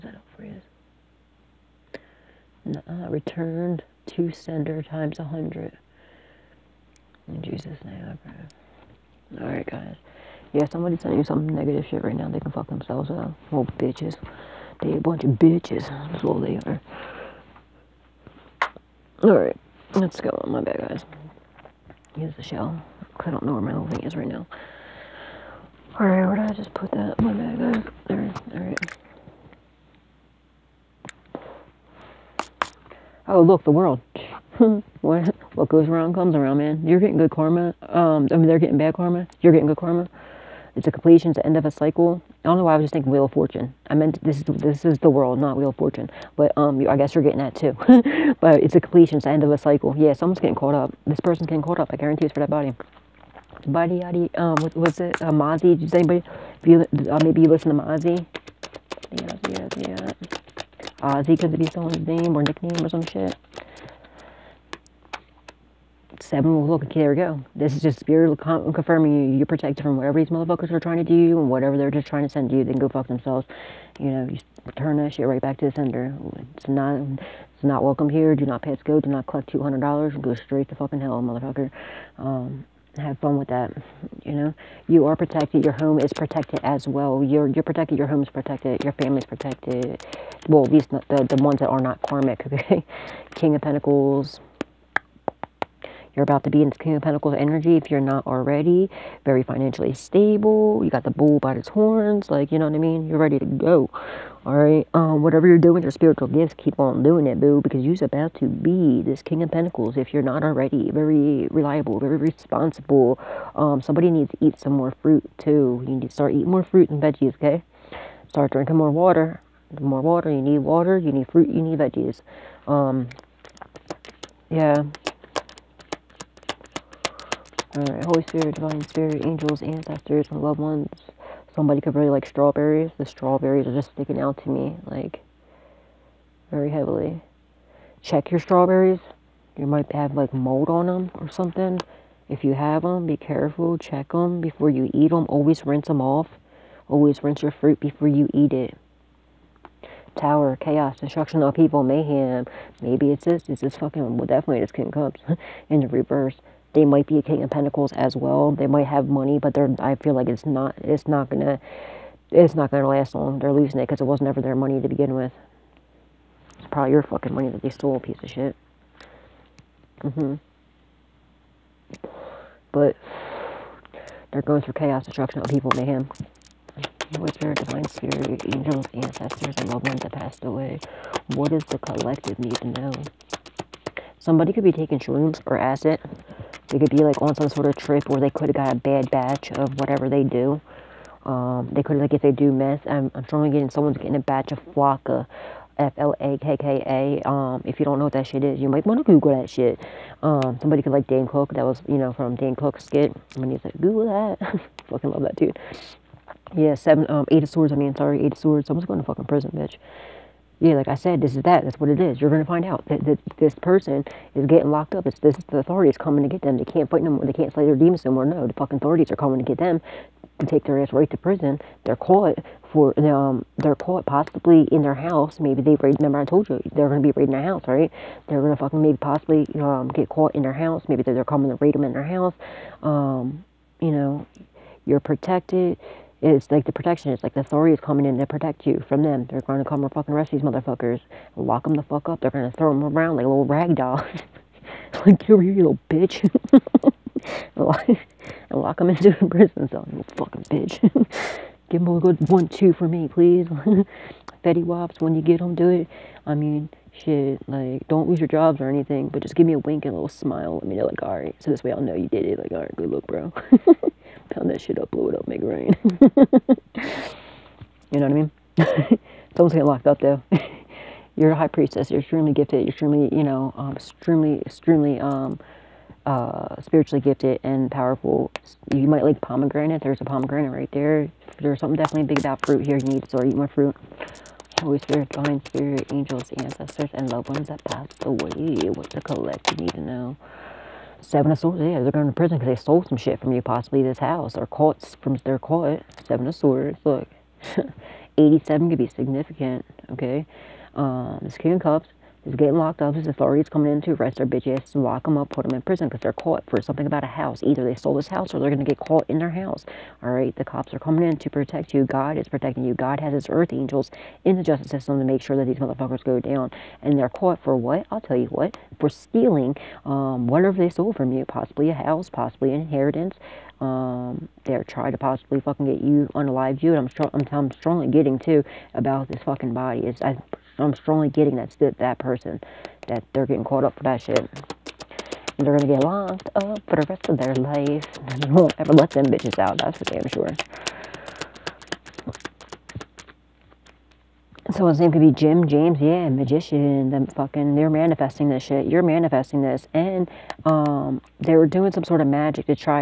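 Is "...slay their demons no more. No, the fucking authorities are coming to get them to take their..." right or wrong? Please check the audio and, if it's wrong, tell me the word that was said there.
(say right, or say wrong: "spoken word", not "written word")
right.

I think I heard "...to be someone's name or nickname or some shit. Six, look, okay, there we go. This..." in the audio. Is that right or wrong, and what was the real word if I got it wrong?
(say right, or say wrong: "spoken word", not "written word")
wrong: "Seven", not "Six".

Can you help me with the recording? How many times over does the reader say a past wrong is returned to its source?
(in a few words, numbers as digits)
100.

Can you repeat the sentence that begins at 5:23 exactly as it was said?
Um, they're trying to possibly fucking get you unalive you, and I'm, str- I'm, I'm strongly getting too about this fucking body.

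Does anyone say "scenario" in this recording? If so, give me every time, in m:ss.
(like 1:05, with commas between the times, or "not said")
not said.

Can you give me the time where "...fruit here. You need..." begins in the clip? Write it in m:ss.
4:42.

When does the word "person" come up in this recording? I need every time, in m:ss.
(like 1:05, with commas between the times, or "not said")
0:51, 3:33, 5:31.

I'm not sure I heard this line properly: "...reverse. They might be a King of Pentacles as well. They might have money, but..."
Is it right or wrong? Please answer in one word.
right.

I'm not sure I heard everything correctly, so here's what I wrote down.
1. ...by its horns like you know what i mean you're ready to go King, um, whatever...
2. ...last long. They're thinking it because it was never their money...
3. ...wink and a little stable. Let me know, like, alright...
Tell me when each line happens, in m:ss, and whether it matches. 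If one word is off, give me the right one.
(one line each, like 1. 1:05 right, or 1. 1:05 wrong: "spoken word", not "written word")
1. 1:41 wrong: "Alright", not "King"
2. 2:42 wrong: "losing", not "thinking"
3. 4:19 wrong: "smile", not "stable".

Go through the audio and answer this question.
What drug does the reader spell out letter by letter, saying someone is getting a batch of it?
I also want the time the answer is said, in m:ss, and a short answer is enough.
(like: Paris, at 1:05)
flakka, at 3:14.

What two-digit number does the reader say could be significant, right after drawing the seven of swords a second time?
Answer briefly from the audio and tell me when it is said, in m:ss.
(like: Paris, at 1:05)
87, at 4:58.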